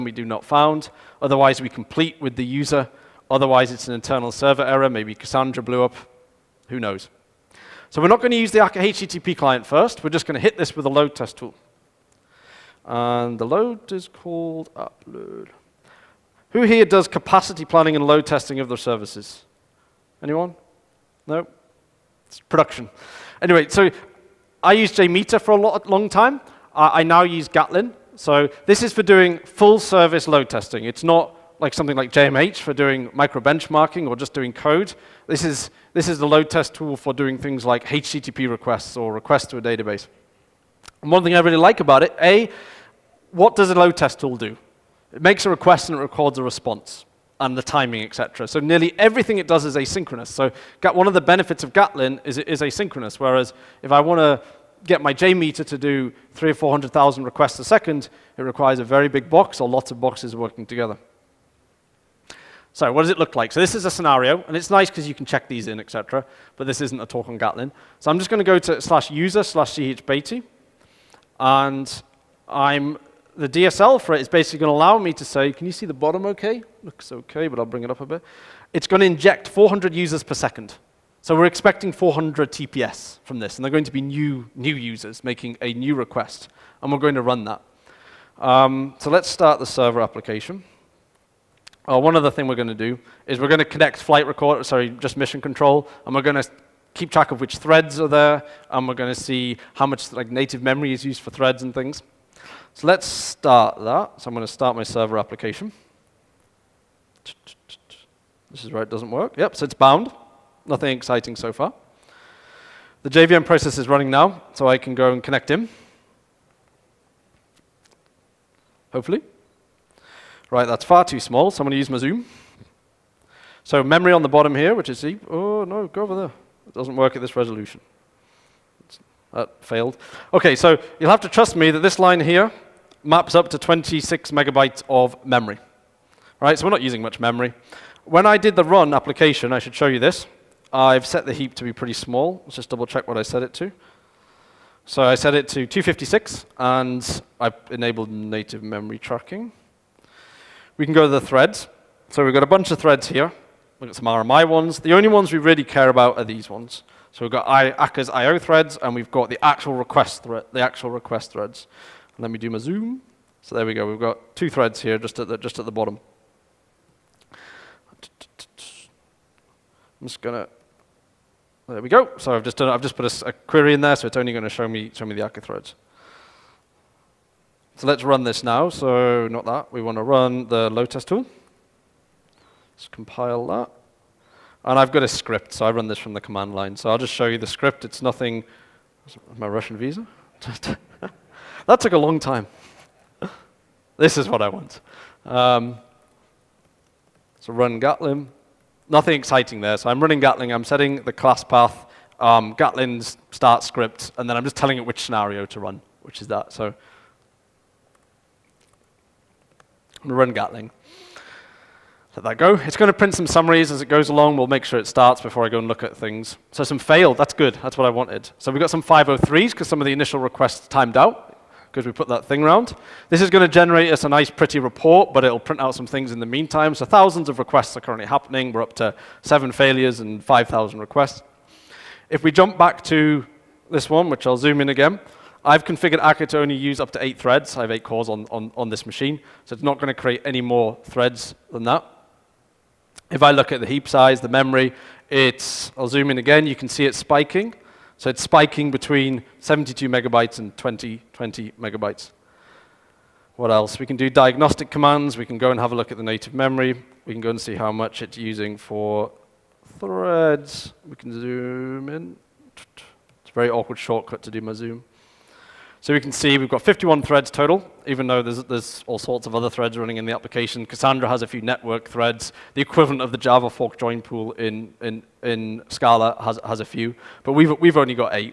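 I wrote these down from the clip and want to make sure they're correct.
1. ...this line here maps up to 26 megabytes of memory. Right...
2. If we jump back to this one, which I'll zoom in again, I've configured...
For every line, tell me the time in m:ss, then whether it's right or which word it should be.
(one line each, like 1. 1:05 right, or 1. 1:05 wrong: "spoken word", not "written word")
1. 2:11 right
2. 3:52 right.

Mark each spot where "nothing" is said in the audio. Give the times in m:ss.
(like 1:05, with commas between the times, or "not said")
1:50, 3:08, 3:18.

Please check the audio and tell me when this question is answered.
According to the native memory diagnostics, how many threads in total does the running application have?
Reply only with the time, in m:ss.
4:26.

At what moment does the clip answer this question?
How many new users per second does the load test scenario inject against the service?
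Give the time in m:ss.
1:19.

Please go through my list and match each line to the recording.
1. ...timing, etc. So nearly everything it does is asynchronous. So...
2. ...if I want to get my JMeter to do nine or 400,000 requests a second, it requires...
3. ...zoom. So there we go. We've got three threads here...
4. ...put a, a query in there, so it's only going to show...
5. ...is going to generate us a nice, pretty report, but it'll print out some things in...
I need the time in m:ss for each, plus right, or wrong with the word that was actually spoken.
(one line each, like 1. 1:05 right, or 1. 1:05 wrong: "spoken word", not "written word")
1. 0:47 right
2. 0:53 wrong: "three", not "nine"
3. 2:42 wrong: "two", not "three"
4. 2:52 right
5. 3:43 right.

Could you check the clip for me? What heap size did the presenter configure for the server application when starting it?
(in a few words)
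256.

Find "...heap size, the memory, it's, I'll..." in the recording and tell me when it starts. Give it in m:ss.
4:03.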